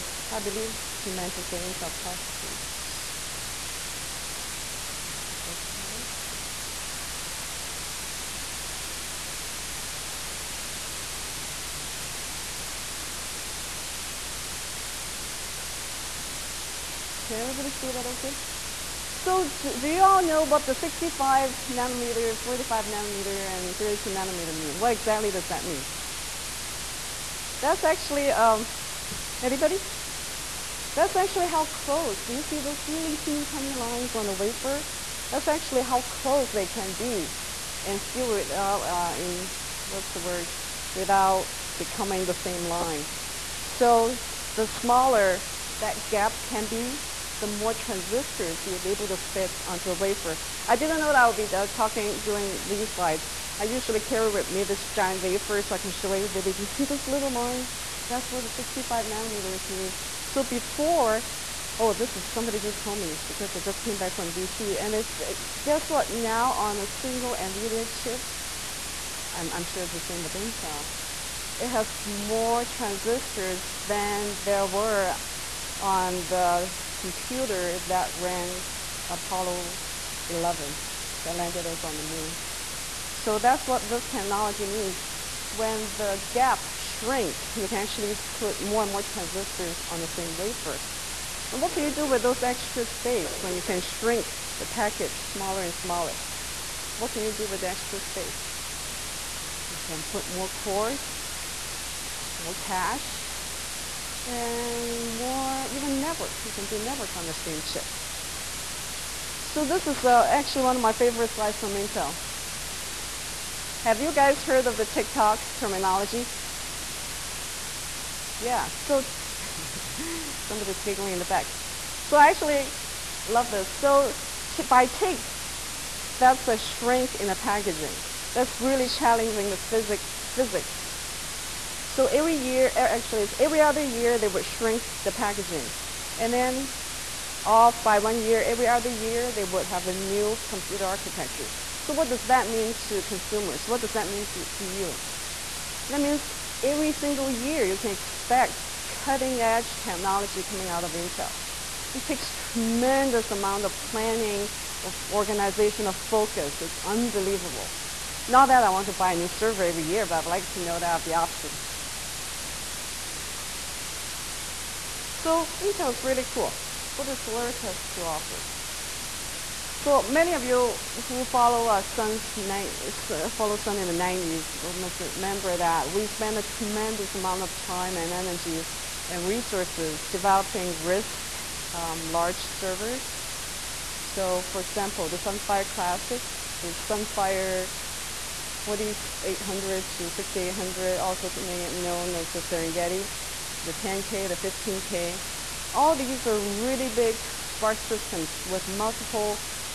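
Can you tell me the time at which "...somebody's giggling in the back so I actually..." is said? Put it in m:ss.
2:00.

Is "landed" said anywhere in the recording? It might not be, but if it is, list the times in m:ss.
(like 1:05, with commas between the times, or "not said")
1:21.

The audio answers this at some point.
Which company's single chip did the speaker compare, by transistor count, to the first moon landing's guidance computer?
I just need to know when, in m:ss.
1:07.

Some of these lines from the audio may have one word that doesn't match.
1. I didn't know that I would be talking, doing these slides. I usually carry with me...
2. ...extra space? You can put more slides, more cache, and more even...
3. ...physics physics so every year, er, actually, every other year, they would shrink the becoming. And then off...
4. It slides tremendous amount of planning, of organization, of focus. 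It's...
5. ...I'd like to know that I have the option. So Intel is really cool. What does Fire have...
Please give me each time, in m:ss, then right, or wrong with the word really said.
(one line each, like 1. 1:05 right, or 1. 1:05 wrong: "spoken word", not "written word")
1. 0:50 right
2. 1:37 wrong: "cores", not "slides"
3. 2:09 wrong: "packaging", not "becoming"
4. 2:31 wrong: "takes", not "slides"
5. 2:40 wrong: "Solaris", not "Fire".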